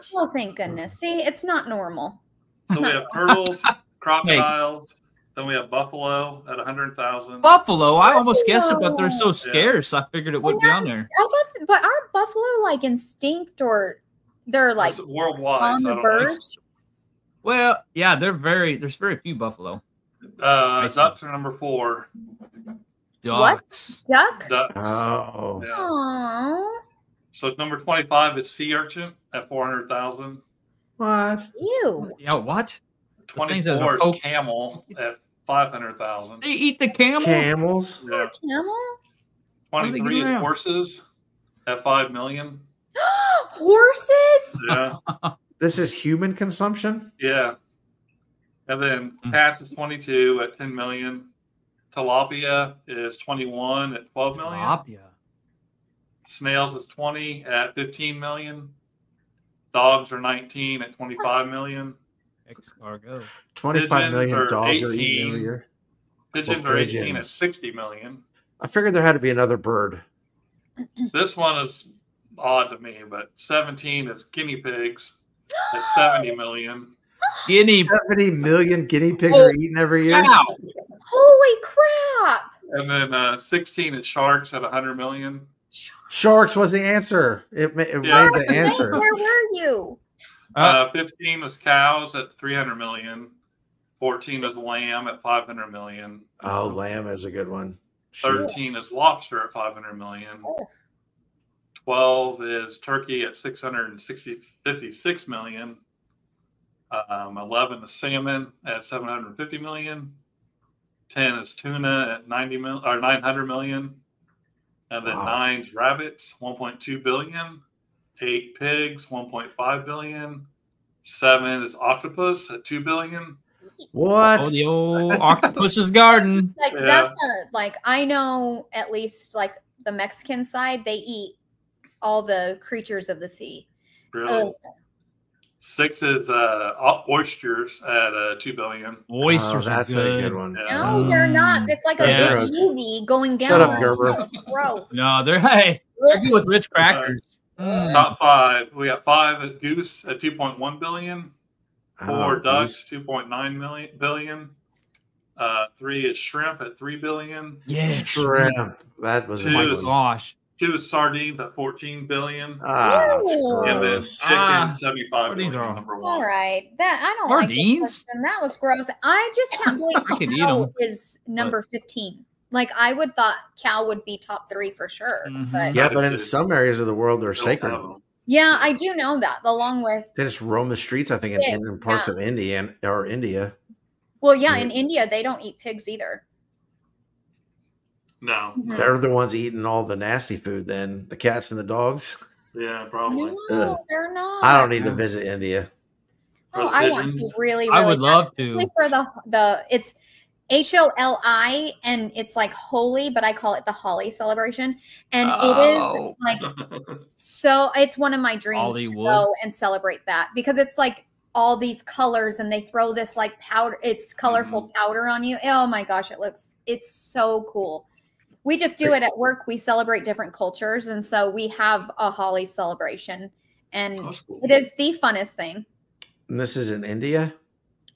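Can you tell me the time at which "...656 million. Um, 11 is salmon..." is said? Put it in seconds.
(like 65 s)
103 s.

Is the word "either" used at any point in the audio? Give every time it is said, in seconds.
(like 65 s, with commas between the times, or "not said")
185 s.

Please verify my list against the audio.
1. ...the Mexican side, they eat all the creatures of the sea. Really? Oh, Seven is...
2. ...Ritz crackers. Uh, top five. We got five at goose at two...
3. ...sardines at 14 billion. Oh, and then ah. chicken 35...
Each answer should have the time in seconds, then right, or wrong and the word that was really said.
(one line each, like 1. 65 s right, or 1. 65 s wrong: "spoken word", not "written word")
1. 129 s wrong: "Six", not "Seven"
2. 146 s right
3. 160 s wrong: "75", not "35".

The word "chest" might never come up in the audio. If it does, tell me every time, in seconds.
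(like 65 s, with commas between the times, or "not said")
not said.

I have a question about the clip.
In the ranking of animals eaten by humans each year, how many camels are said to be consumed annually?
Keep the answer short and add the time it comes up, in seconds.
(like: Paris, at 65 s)
500,000, at 35 s.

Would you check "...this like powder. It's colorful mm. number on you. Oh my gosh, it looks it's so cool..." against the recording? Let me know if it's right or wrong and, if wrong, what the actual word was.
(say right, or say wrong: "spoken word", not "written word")
wrong: "powder", not "number".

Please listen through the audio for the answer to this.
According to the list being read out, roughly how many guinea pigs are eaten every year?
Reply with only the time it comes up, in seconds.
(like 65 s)
75 s.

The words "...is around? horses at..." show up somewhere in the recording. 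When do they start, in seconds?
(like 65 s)
40 s.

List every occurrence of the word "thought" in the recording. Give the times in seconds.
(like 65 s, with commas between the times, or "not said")
11 s, 173 s.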